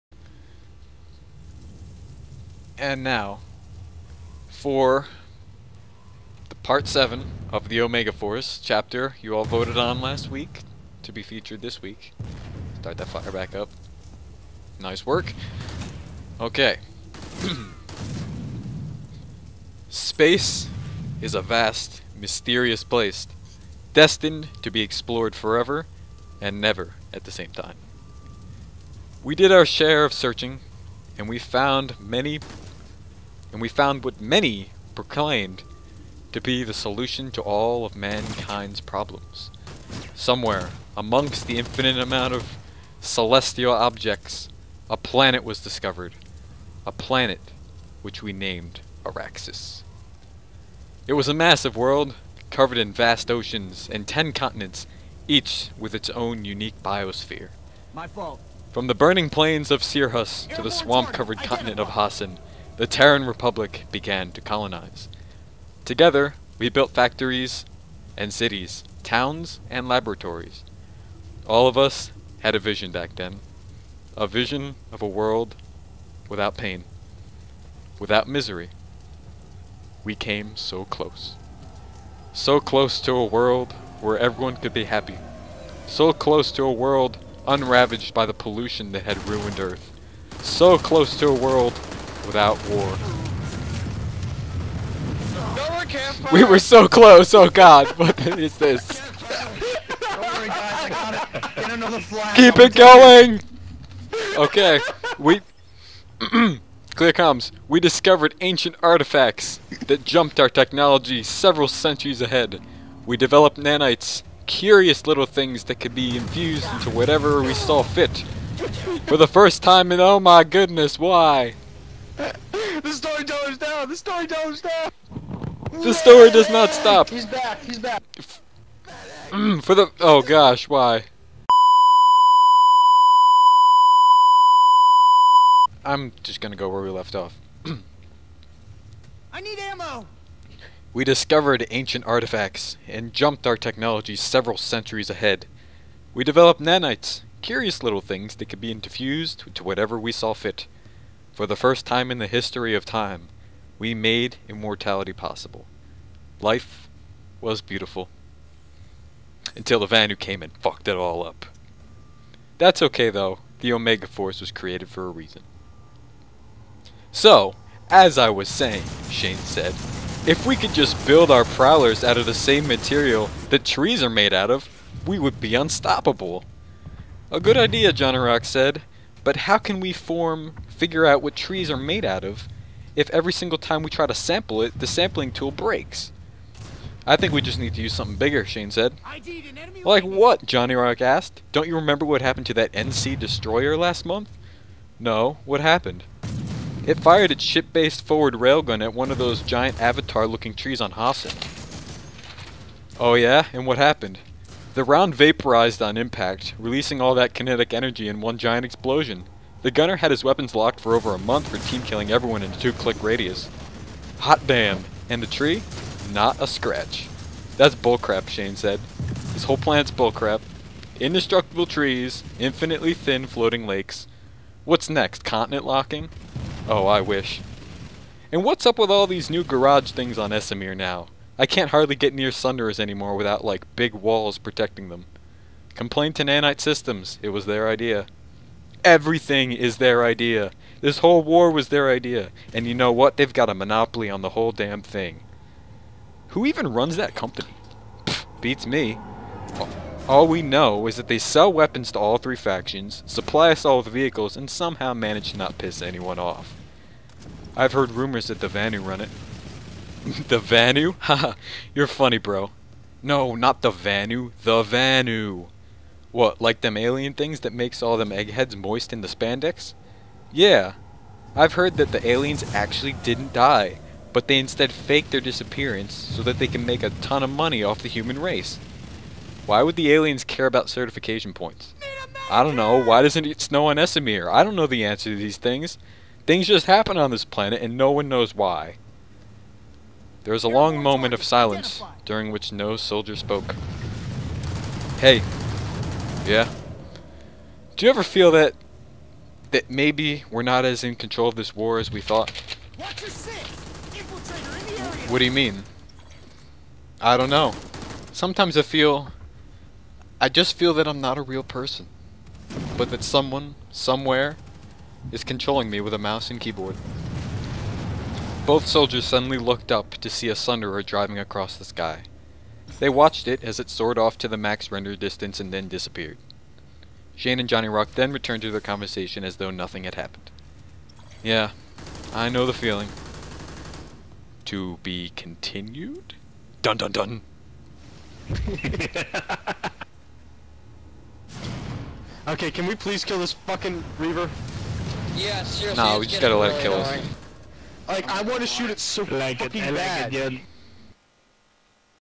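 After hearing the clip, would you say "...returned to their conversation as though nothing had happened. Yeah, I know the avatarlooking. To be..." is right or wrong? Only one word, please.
wrong.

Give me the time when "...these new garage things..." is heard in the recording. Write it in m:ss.
3:49.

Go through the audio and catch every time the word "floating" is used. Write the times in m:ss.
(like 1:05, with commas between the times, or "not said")
3:43.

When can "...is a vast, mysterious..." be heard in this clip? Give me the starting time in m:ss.
0:21.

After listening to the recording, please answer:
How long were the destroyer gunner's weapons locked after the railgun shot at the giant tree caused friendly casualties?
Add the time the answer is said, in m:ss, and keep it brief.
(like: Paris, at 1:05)
over a month, at 3:30.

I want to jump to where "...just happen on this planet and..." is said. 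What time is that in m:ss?
4:46.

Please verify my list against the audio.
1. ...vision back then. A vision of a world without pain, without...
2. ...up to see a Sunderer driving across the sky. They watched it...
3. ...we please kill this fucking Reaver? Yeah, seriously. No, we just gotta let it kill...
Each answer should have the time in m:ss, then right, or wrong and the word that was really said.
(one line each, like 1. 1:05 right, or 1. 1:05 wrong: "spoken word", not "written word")
1. 1:12 right
2. 5:19 right
3. 5:42 right.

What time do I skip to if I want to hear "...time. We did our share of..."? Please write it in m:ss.
0:27.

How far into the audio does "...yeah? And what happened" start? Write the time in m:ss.
3:23.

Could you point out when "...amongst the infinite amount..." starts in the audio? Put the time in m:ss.
0:40.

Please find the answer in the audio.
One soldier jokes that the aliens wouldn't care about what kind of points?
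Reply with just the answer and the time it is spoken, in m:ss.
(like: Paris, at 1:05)
certification points, at 4:40.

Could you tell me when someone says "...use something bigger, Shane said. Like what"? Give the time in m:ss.
3:07.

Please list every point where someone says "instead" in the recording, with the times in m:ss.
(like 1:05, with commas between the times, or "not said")
4:34.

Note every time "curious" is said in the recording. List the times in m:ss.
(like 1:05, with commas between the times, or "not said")
1:54, 2:27.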